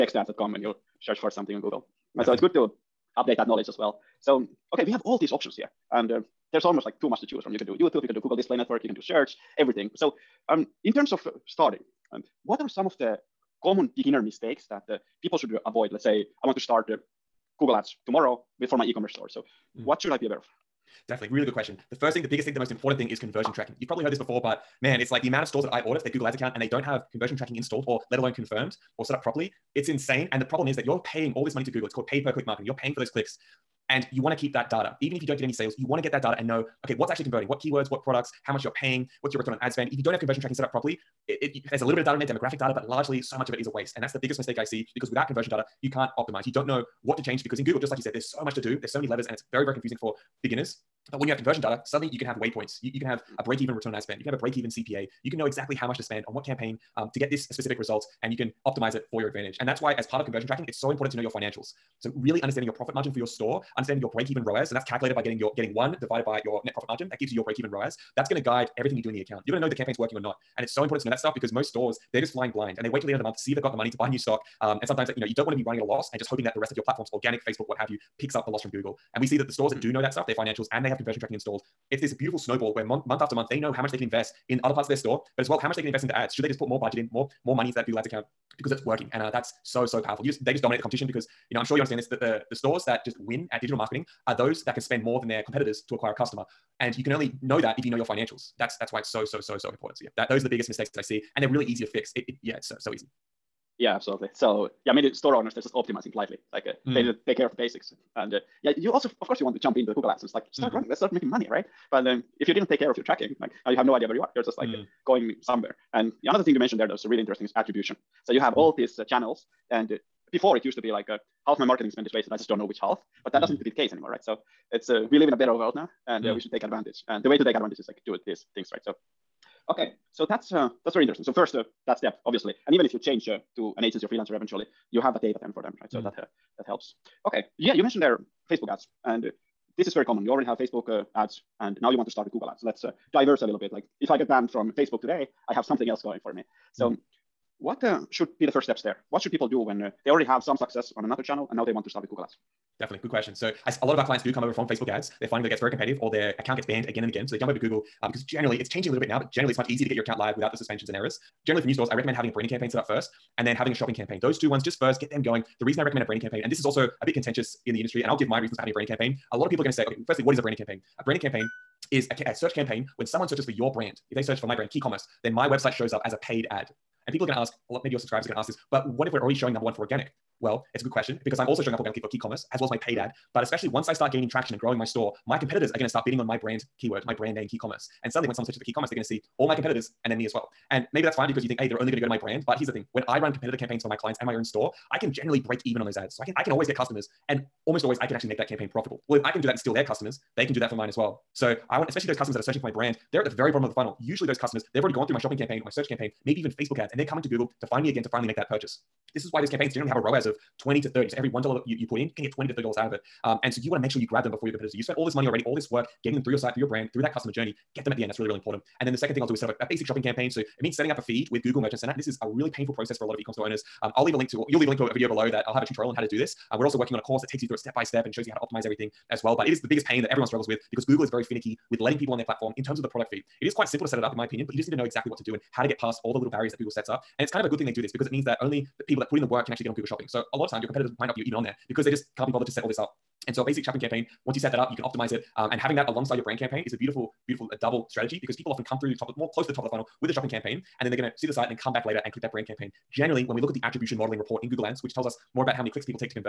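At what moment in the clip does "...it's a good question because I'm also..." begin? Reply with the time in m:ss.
3:00.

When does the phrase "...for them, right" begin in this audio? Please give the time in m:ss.
2:15.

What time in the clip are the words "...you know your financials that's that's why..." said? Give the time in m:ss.
1:37.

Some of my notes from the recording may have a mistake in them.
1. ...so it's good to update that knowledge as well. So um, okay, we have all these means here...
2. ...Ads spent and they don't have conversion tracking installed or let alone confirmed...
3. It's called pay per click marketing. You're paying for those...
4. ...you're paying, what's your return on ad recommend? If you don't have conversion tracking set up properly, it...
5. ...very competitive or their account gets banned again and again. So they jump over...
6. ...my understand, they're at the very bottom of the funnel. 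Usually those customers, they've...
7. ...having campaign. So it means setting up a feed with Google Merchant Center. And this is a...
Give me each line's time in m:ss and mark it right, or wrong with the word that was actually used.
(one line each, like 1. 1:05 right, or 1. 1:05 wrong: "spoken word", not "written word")
1. 0:02 wrong: "options", not "means"
2. 0:26 wrong: "account", not "spent"
3. 0:31 right
4. 0:38 wrong: "spend", not "recommend"
5. 2:35 right
6. 3:22 wrong: "brand", not "understand"
7. 3:39 wrong: "shopping", not "having".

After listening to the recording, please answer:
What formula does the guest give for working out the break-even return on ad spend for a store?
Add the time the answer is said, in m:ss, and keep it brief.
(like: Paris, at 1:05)
1 divided by net profit margin, at 1:05.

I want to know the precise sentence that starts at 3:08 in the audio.
And suddenly, when someone searches the key commerce, they're going to see all my competitors and then me as well.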